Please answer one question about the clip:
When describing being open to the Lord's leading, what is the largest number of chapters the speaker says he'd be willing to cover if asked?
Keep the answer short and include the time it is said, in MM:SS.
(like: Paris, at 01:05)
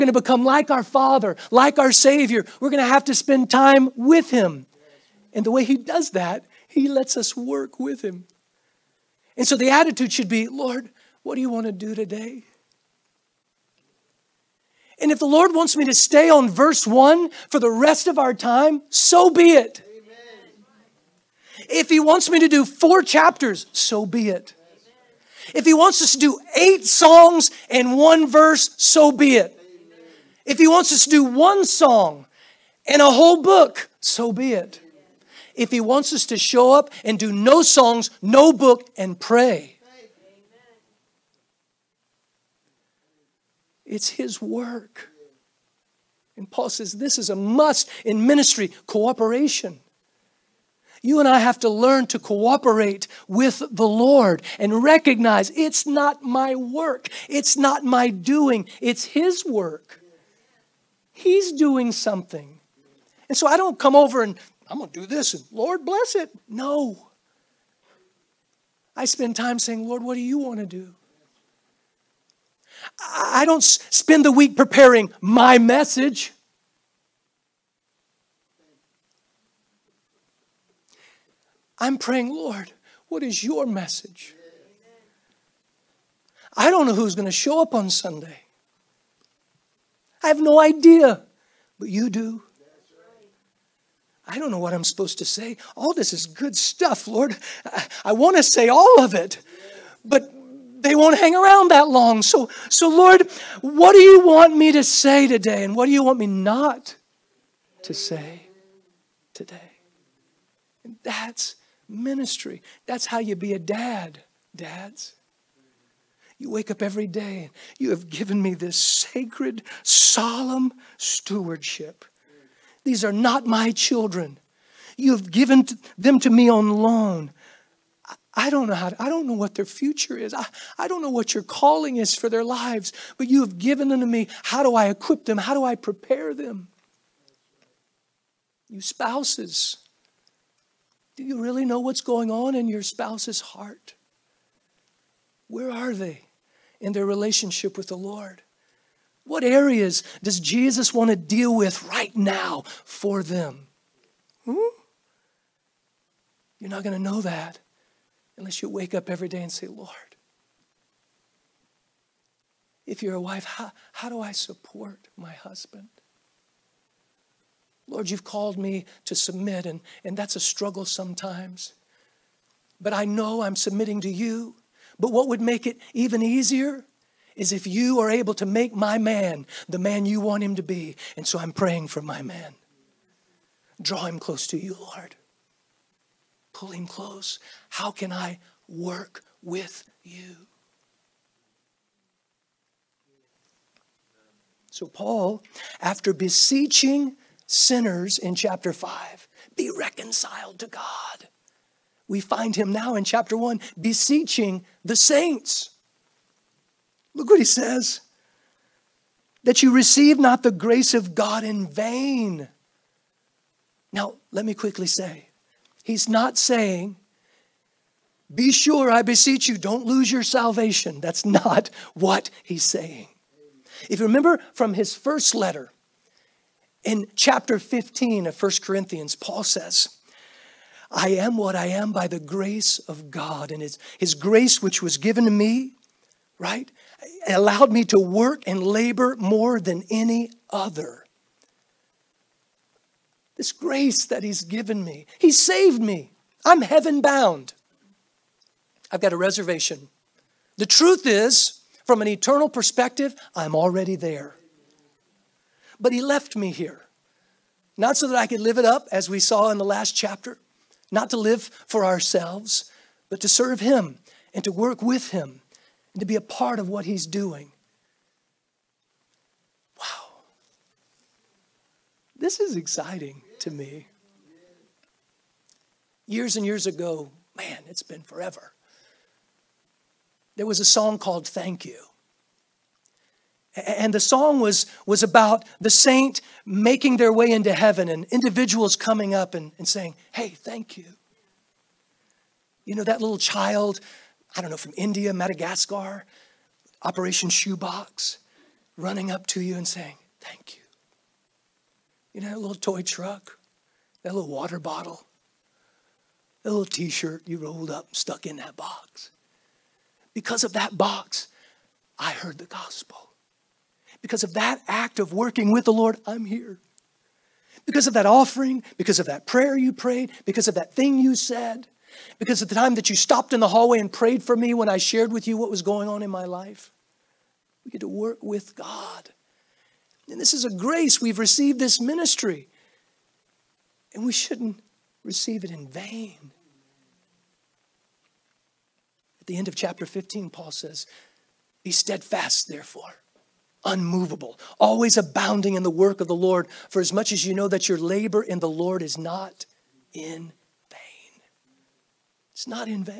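4, at 00:22.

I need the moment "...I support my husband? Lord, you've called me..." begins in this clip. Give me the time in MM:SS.
02:44.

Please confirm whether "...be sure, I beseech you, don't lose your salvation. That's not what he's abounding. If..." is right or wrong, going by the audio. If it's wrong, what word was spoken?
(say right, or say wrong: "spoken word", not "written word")
wrong: "saying", not "abounding".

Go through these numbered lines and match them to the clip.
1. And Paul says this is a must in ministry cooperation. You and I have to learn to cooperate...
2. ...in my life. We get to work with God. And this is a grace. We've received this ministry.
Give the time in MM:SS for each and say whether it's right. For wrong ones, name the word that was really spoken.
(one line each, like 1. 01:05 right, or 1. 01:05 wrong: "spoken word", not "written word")
1. 00:46 right
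2. 05:26 right.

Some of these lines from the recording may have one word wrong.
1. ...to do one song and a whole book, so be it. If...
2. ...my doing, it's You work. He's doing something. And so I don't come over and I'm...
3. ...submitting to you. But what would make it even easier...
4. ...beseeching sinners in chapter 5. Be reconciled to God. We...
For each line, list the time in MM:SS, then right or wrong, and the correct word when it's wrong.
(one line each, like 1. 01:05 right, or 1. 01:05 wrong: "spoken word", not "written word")
1. 00:31 right
2. 00:57 wrong: "His", not "You"
3. 02:53 right
4. 03:16 right.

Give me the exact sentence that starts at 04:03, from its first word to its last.
This grace that he's given me, he saved me.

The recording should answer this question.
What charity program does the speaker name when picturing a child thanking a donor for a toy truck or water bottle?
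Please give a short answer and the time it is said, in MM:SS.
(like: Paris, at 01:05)
Operation Shoebox, at 04:56.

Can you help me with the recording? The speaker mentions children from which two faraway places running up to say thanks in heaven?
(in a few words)
India, Madagascar.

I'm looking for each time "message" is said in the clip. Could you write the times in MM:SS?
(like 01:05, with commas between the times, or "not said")
01:15, 01:23.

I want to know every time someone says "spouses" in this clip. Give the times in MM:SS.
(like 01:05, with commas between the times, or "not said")
02:18, 02:22.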